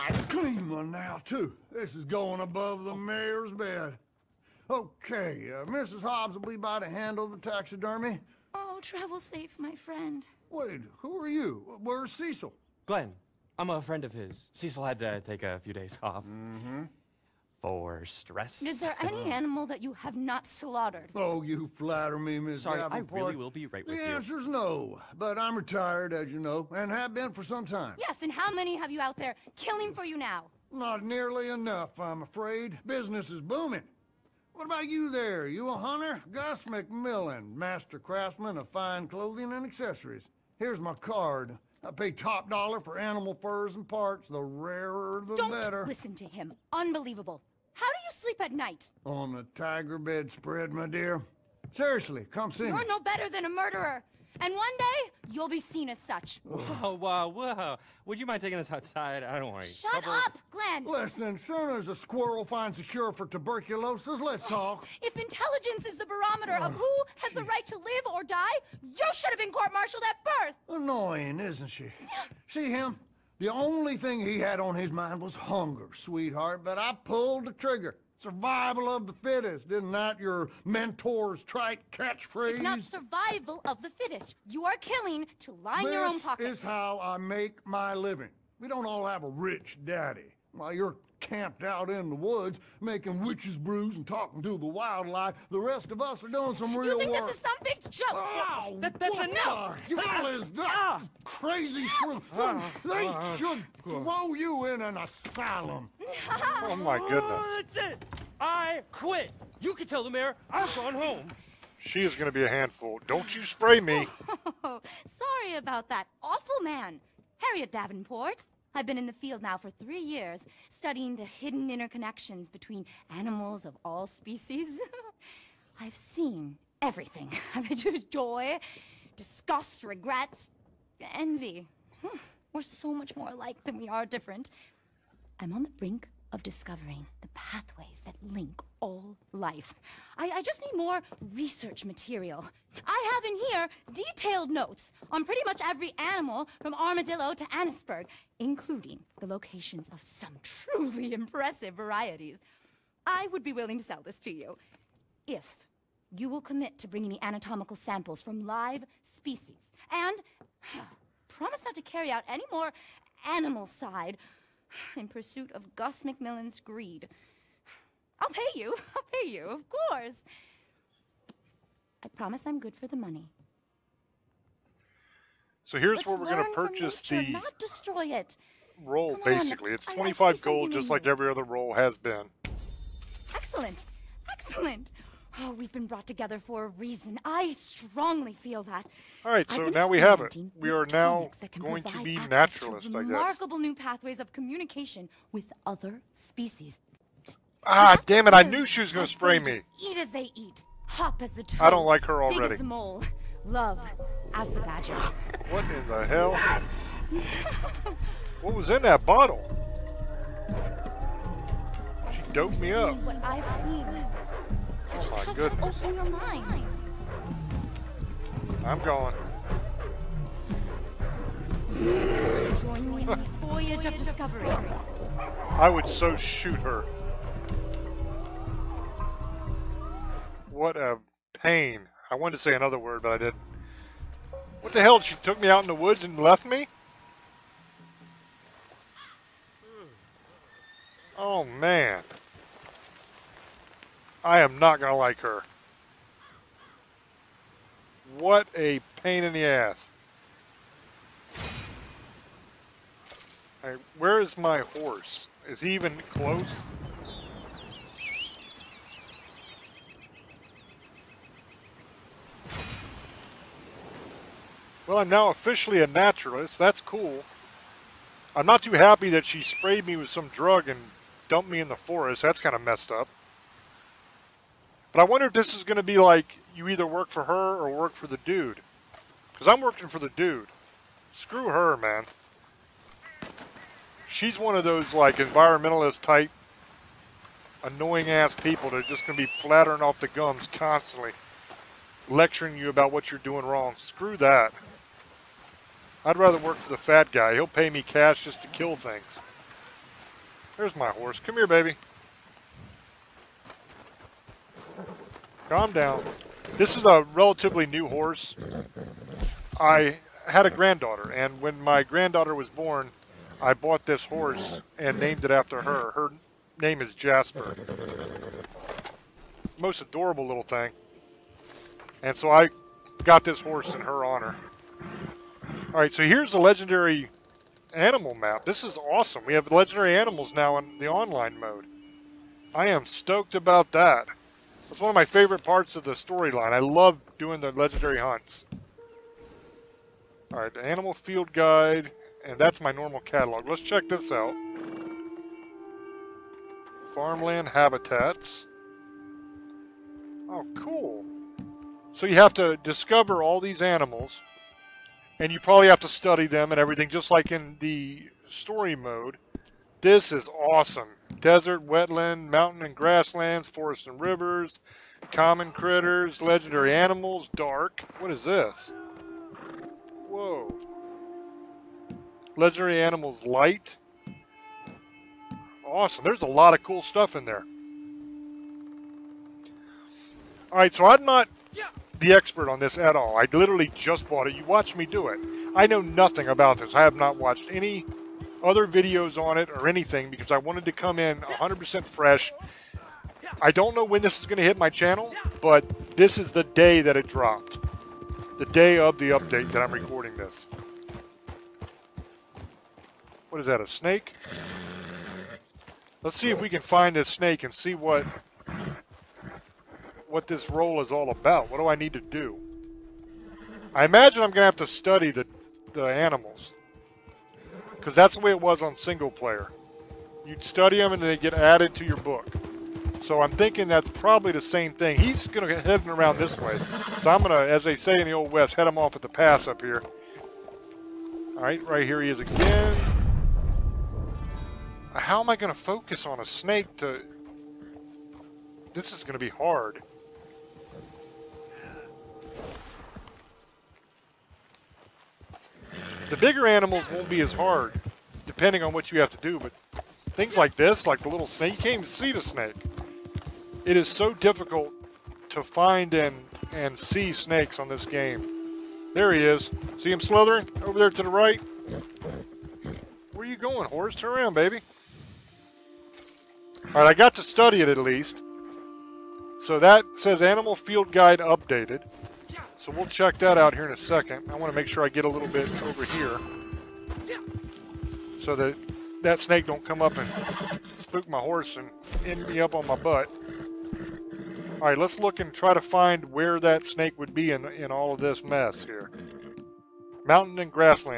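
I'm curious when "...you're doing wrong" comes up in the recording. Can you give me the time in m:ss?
4:53.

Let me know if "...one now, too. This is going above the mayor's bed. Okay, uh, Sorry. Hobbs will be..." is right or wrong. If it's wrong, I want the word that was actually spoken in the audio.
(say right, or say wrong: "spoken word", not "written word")
wrong: "Mrs", not "Sorry".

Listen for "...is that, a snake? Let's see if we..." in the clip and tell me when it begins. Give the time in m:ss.
6:43.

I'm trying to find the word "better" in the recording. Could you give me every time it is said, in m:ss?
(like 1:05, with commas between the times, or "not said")
0:45, 0:52.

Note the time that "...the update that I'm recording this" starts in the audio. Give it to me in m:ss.
6:38.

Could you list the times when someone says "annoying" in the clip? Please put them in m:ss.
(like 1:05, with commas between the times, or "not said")
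1:10, 4:47.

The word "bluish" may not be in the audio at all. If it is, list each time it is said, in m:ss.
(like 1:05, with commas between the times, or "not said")
not said.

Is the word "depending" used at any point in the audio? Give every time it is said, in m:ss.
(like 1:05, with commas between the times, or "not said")
7:28.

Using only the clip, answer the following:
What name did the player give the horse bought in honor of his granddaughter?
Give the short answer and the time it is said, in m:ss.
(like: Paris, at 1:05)
Jasper, at 5:16.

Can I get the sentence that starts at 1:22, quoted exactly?
It's not survival of the fittest.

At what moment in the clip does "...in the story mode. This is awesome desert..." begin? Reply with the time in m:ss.
5:57.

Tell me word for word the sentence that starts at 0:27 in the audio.
Yes, and how many have you out there killing for you now?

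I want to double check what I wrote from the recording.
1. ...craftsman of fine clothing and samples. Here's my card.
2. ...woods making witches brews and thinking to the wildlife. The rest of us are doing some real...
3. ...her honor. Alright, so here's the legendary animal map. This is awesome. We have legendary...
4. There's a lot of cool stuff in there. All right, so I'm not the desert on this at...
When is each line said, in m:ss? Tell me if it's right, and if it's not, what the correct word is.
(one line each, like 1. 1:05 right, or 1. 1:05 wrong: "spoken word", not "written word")
1. 0:37 wrong: "accessories", not "samples"
2. 1:32 wrong: "talking", not "thinking"
3. 5:23 right
4. 6:16 wrong: "expert", not "desert".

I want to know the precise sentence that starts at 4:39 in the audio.
Because I'm working for the dude.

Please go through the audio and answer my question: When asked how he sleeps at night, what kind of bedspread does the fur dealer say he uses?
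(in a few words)
Tiger bedspread.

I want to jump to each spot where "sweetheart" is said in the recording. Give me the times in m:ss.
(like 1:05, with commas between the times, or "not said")
1:15.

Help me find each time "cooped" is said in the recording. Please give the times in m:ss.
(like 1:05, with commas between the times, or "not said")
not said.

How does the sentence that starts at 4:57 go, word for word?
He'll pay me cash just to kill things.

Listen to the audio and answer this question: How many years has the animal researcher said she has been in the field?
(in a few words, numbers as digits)
3.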